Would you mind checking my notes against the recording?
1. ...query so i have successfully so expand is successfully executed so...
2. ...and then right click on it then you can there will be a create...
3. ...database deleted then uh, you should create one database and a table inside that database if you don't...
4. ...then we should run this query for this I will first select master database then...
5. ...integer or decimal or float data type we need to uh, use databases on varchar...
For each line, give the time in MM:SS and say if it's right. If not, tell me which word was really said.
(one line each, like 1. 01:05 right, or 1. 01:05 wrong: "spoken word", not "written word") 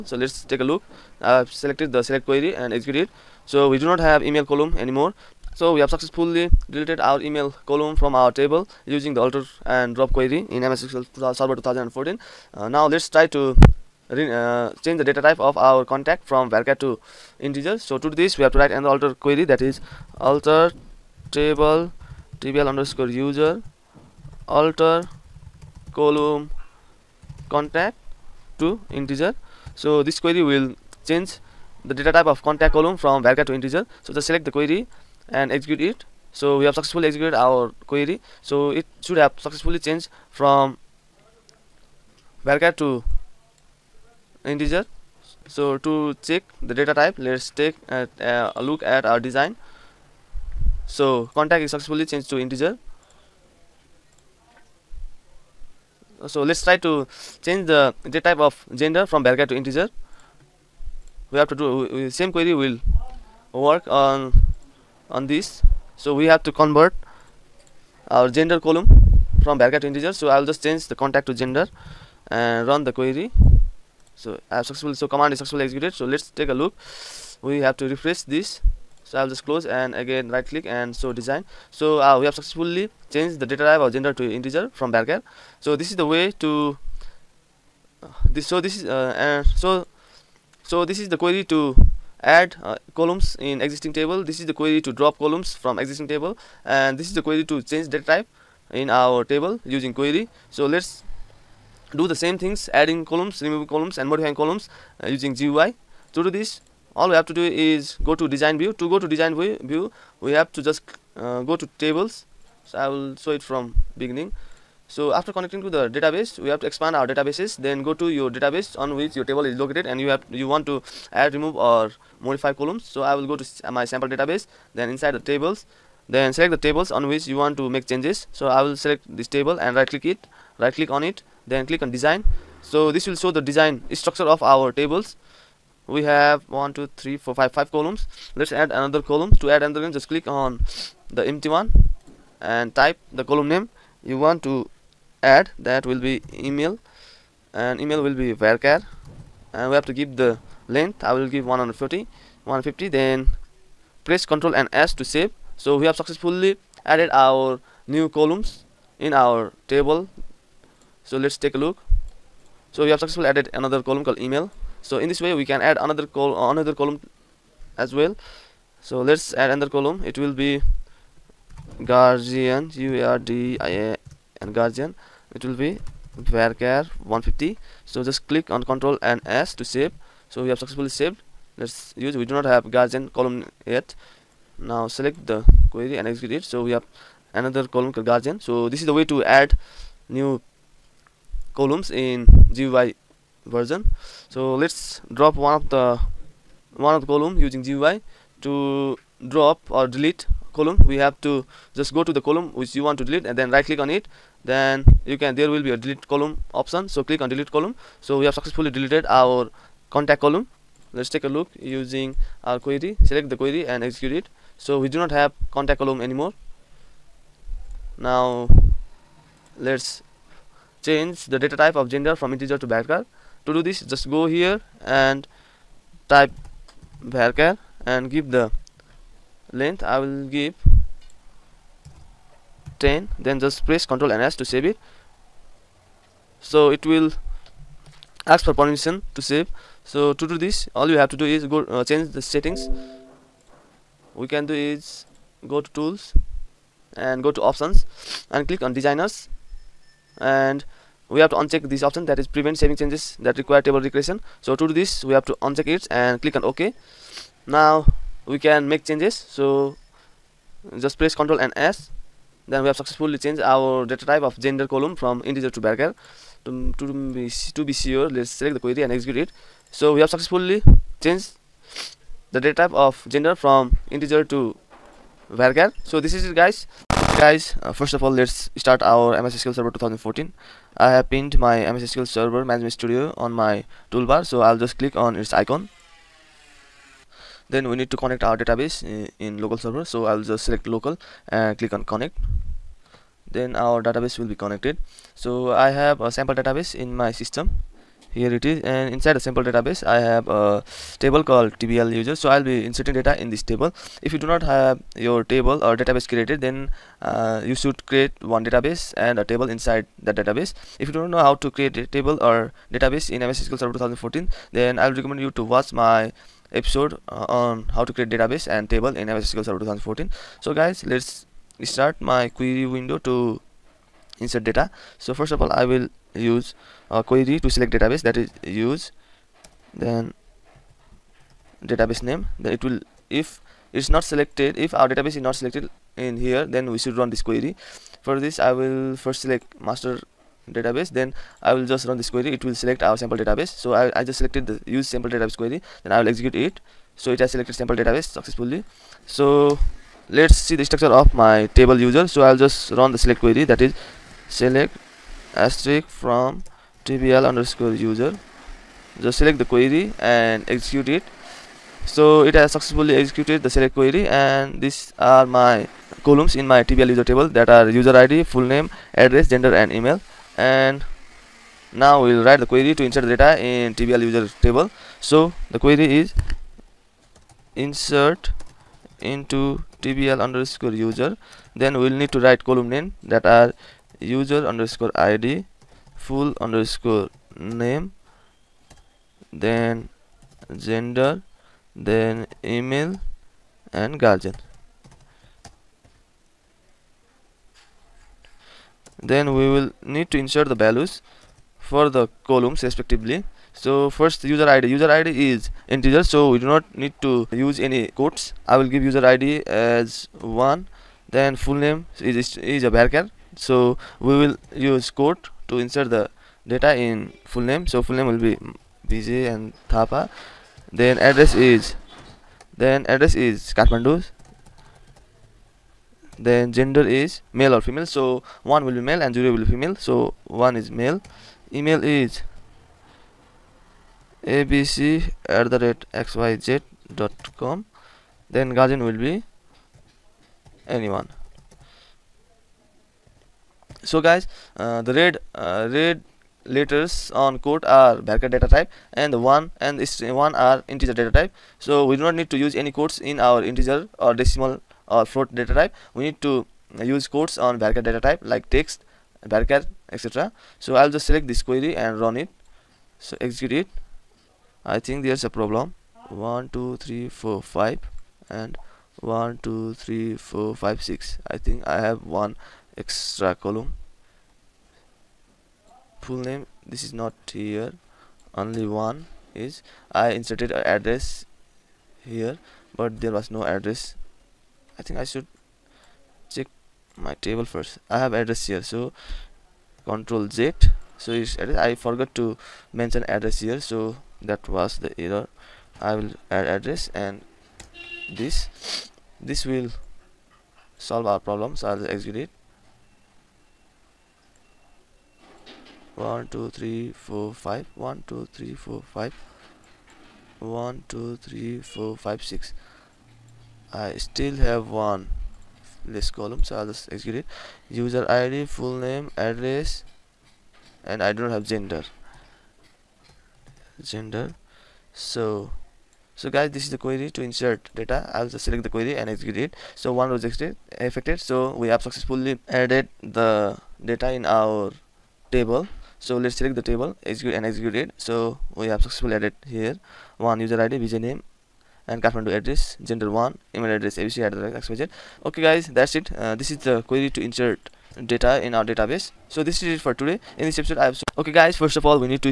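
1. 01:12 wrong: "command", not "expand"
2. 03:23 wrong: "delete", not "create"
3. 05:05 wrong: "created", not "deleted"
4. 05:36 right
5. 07:33 wrong: "quotes", not "databases".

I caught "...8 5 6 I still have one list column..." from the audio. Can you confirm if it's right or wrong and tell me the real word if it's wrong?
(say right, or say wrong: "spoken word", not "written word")
wrong: "4", not "8".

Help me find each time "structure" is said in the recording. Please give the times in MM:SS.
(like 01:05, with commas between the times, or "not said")
02:13, 05:50.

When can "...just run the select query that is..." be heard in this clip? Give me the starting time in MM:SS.
05:52.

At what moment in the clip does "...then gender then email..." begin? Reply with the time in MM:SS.
06:29.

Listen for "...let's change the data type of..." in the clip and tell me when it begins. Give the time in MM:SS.
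03:39.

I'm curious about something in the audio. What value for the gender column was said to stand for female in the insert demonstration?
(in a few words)
0.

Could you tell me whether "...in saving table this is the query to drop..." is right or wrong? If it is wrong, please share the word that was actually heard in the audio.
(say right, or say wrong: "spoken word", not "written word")
wrong: "existing", not "saving".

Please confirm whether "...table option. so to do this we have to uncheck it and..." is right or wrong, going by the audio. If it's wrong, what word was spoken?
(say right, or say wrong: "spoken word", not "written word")
wrong: "recreation", not "option".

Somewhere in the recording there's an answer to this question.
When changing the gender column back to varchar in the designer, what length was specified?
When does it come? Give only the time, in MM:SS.
03:52.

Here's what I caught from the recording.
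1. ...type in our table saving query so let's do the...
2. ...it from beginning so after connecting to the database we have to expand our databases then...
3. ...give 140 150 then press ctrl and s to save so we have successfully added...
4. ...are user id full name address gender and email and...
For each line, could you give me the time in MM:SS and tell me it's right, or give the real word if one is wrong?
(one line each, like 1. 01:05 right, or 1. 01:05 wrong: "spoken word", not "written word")
1. 01:38 wrong: "using", not "saving"
2. 01:53 right
3. 02:31 right
4. 06:07 right.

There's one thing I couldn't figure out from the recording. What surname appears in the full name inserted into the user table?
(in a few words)
Thapa.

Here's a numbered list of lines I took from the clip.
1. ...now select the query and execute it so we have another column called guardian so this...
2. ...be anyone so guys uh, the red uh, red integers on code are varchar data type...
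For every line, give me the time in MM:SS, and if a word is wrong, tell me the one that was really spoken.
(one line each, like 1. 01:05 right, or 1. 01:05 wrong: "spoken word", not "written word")
1. 03:04 right
2. 07:18 wrong: "letters", not "integers".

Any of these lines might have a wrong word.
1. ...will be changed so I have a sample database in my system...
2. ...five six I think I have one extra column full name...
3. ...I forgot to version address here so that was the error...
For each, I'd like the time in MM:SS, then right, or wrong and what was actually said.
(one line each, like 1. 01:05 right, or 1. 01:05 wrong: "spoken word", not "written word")
1. 04:54 wrong: "connected", not "changed"
2. 07:50 right
3. 08:11 wrong: "mention", not "version".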